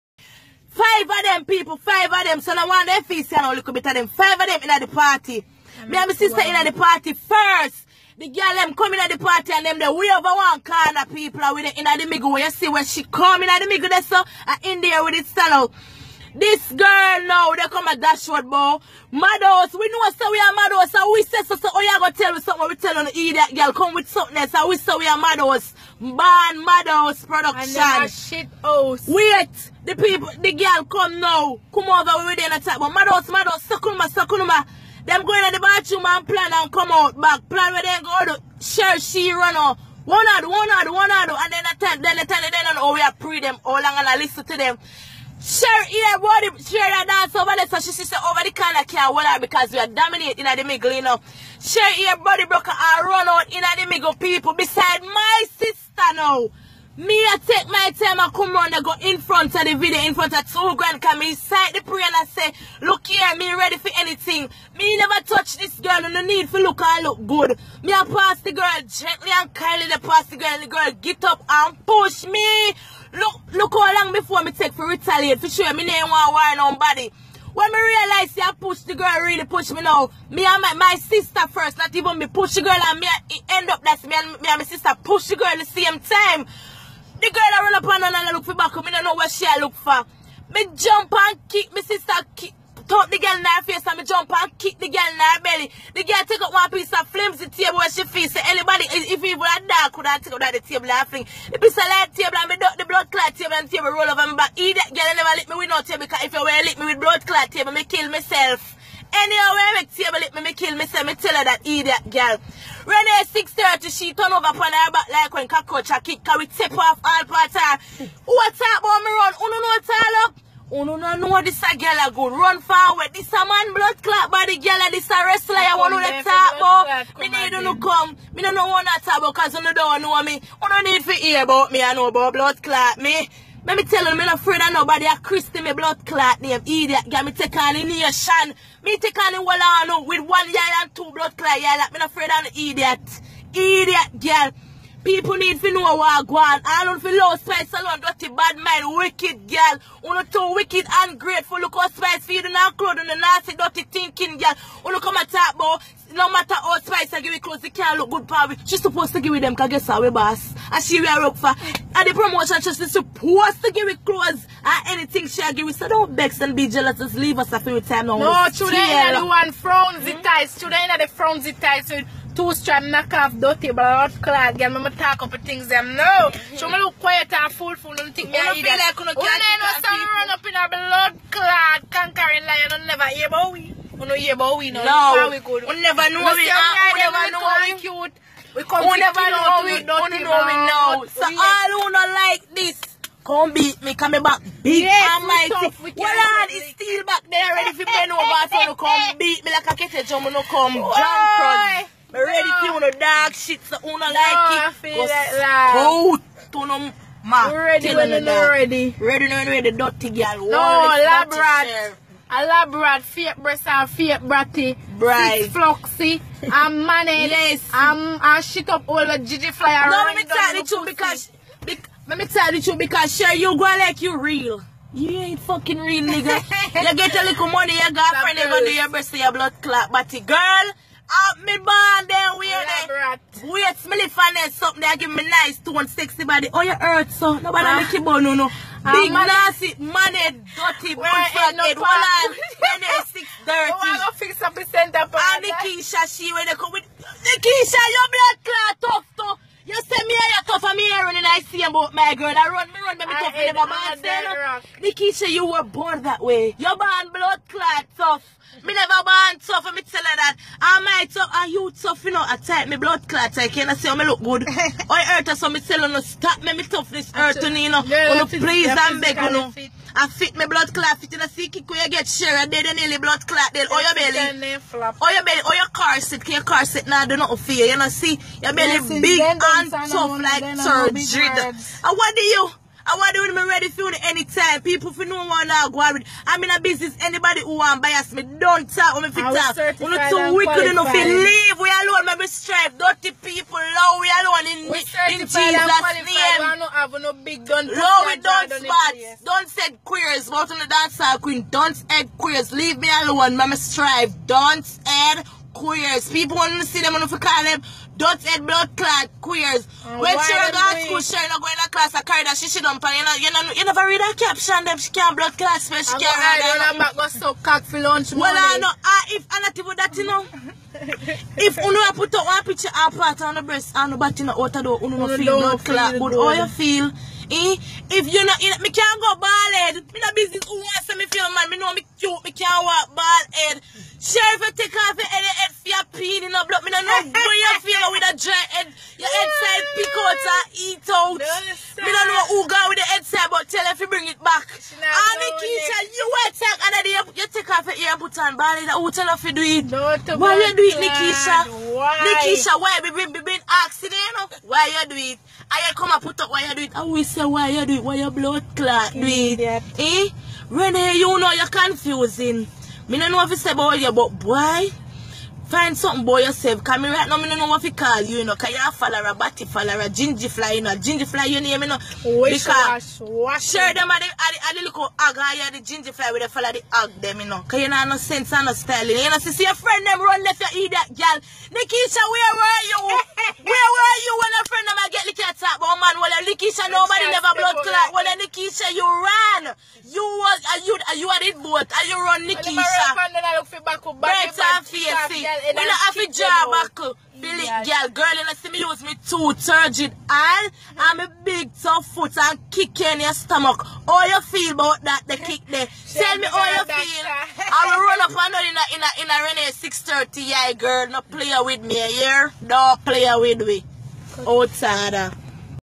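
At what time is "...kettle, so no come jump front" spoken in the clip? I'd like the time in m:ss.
3:19.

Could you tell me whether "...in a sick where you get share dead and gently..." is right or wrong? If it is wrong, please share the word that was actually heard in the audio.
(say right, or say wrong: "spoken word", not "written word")
wrong: "nearly", not "gently".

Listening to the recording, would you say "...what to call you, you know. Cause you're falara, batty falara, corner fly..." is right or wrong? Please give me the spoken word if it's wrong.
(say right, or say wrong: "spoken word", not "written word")
wrong: "ginger", not "corner".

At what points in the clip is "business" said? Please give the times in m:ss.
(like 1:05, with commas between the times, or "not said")
4:46, 5:30.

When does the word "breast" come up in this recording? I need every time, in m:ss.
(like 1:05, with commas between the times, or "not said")
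3:33, 5:23.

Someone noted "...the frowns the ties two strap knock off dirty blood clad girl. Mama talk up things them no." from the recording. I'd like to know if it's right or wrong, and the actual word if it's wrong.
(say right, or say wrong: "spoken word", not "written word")
right.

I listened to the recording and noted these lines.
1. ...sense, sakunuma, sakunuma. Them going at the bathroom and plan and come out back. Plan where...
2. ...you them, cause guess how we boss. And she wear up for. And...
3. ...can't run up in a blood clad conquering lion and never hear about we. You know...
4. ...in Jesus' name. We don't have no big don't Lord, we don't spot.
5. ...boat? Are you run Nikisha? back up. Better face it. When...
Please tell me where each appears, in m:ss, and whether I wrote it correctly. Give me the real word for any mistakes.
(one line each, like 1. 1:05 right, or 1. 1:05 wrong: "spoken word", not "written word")
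1. 0:33 wrong: "madhouse", not "sense"
2. 2:39 right
3. 2:59 right
4. 4:54 right
5. 6:31 right.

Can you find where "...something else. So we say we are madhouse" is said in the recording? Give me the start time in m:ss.
0:24.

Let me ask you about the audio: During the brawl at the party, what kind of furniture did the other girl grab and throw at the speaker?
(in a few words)
flimsy table.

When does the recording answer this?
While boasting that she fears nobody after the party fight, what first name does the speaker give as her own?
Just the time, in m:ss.
2:15.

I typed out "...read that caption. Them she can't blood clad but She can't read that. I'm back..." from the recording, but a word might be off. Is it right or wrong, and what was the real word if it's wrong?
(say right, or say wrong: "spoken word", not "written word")
right.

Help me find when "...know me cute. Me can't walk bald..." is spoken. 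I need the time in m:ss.
5:31.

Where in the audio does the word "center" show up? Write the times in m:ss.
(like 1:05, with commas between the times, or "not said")
4:04.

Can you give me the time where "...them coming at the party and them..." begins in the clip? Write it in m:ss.
0:08.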